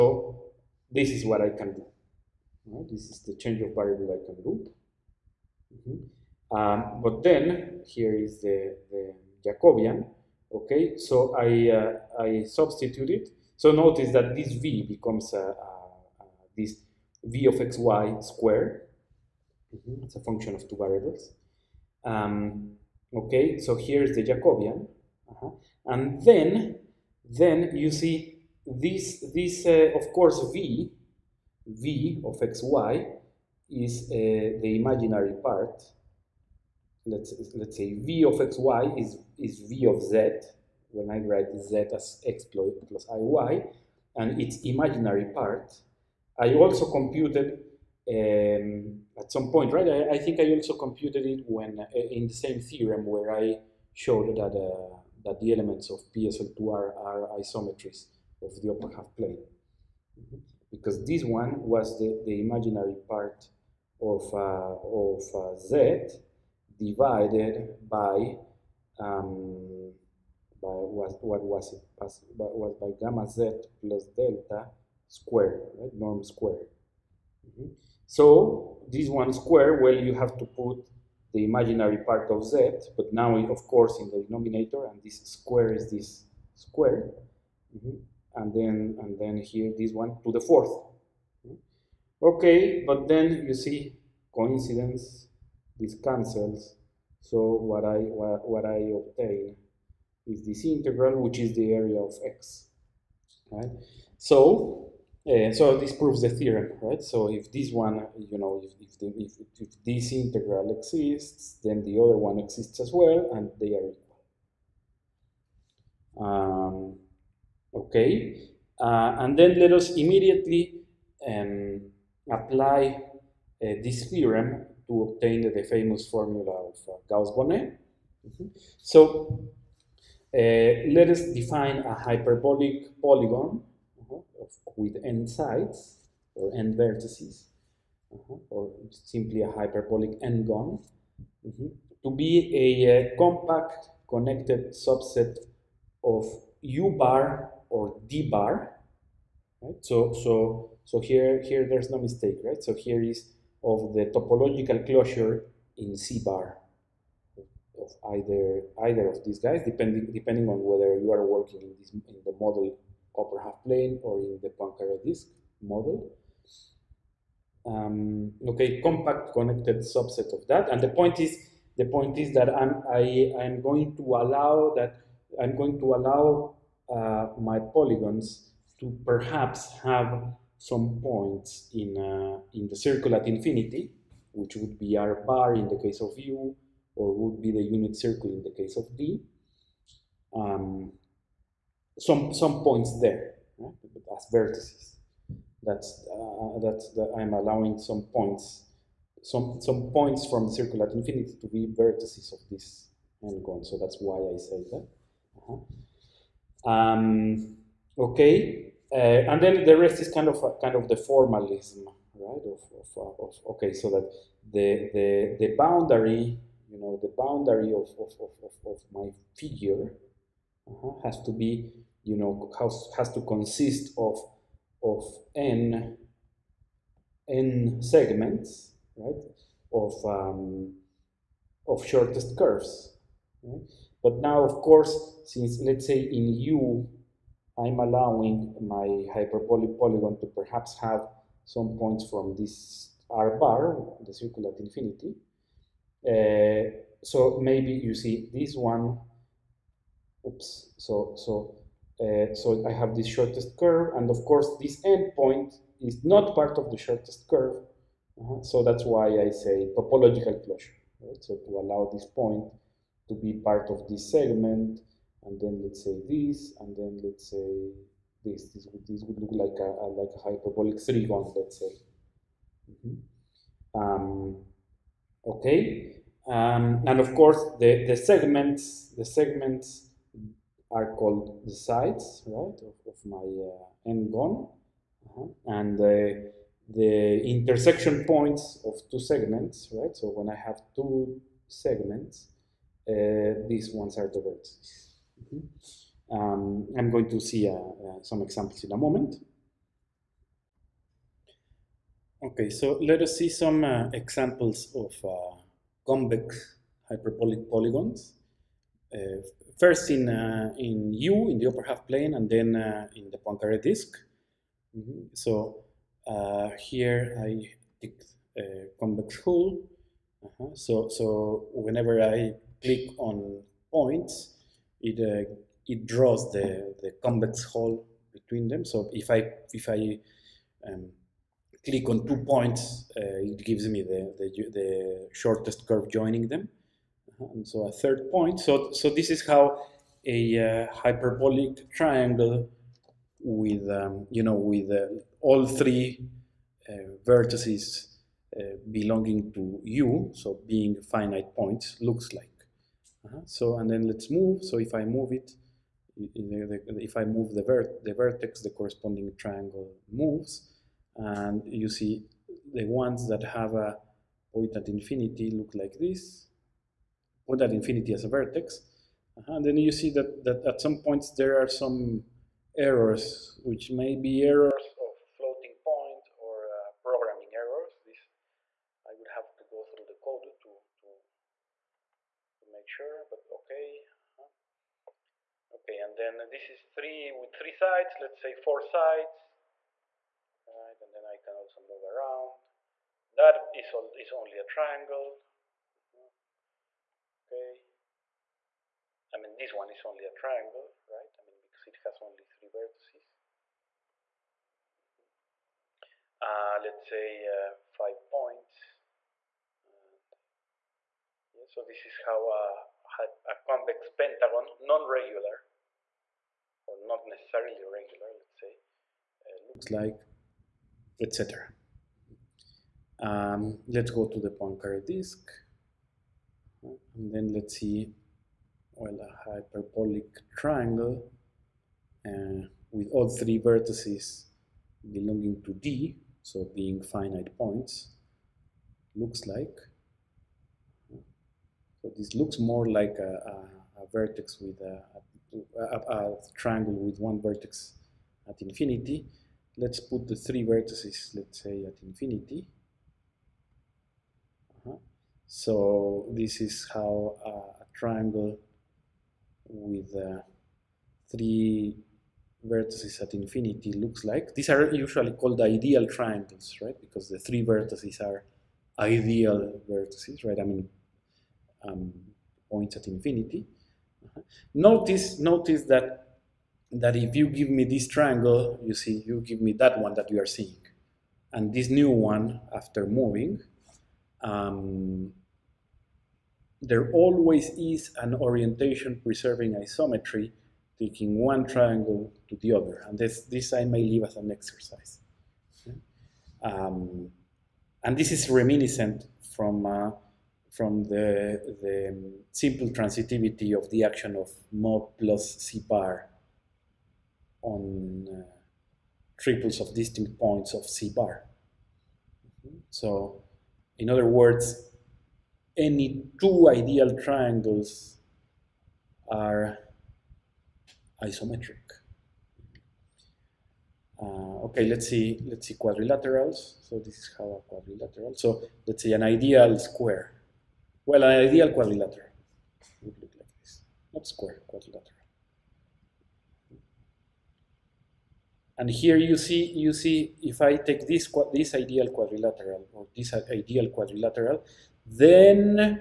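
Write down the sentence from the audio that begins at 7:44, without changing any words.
These are usually called ideal triangles, right?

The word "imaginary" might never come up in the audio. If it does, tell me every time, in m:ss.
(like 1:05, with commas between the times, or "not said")
0:34, 0:44, 1:02, 1:21.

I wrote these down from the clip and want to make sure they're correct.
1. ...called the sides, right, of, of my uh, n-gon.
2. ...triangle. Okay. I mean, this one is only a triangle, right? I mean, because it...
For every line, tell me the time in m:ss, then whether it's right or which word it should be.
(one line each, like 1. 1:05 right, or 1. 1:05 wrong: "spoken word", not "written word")
1. 4:40 right
2. 6:34 right.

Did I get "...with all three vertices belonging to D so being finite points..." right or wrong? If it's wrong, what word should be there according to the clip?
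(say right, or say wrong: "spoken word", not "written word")
right.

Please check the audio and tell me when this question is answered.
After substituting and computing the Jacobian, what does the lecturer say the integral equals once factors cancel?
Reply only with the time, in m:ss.
1:41.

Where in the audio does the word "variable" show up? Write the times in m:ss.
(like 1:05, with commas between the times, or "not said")
0:03, 0:20.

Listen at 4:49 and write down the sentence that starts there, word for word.
So when I have two segments, uh, these ones are the vertices.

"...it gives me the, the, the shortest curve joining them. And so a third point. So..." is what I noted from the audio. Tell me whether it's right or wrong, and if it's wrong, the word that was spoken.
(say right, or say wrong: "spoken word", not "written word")
right.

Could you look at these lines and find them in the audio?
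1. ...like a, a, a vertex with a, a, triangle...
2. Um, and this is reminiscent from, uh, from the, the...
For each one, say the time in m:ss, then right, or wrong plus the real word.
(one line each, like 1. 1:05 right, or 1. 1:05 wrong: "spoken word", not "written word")
1. 7:22 right
2. 8:16 right.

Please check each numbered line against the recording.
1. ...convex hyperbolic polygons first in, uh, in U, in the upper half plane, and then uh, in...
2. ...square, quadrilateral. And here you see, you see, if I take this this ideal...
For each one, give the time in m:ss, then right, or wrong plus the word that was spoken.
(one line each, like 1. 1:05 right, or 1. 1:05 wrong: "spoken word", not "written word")
1. 5:05 right
2. 8:54 right.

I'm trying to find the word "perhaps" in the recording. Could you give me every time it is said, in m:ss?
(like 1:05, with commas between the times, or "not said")
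2:59, 4:00.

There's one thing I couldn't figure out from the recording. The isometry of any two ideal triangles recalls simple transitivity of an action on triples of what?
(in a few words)
distinct points of C bar.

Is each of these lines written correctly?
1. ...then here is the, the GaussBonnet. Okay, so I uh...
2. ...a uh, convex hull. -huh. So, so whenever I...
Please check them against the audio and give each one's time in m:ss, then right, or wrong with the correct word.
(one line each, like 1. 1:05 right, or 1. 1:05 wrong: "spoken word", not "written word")
1. 0:07 wrong: "Jacobian", not "GaussBonnet"
2. 5:17 right.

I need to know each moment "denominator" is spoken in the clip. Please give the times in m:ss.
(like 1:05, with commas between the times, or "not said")
1:24.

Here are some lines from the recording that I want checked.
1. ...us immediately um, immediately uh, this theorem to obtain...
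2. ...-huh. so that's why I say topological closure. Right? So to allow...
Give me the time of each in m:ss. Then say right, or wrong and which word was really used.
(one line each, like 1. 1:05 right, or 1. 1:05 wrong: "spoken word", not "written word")
1. 1:59 wrong: "apply", not "immediately"
2. 4:18 right.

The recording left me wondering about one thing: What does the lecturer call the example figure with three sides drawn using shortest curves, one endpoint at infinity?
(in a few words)
hyperbolic trigon.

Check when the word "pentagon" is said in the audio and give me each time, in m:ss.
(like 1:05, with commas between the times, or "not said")
6:53.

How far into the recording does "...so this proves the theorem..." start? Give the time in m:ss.
1:45.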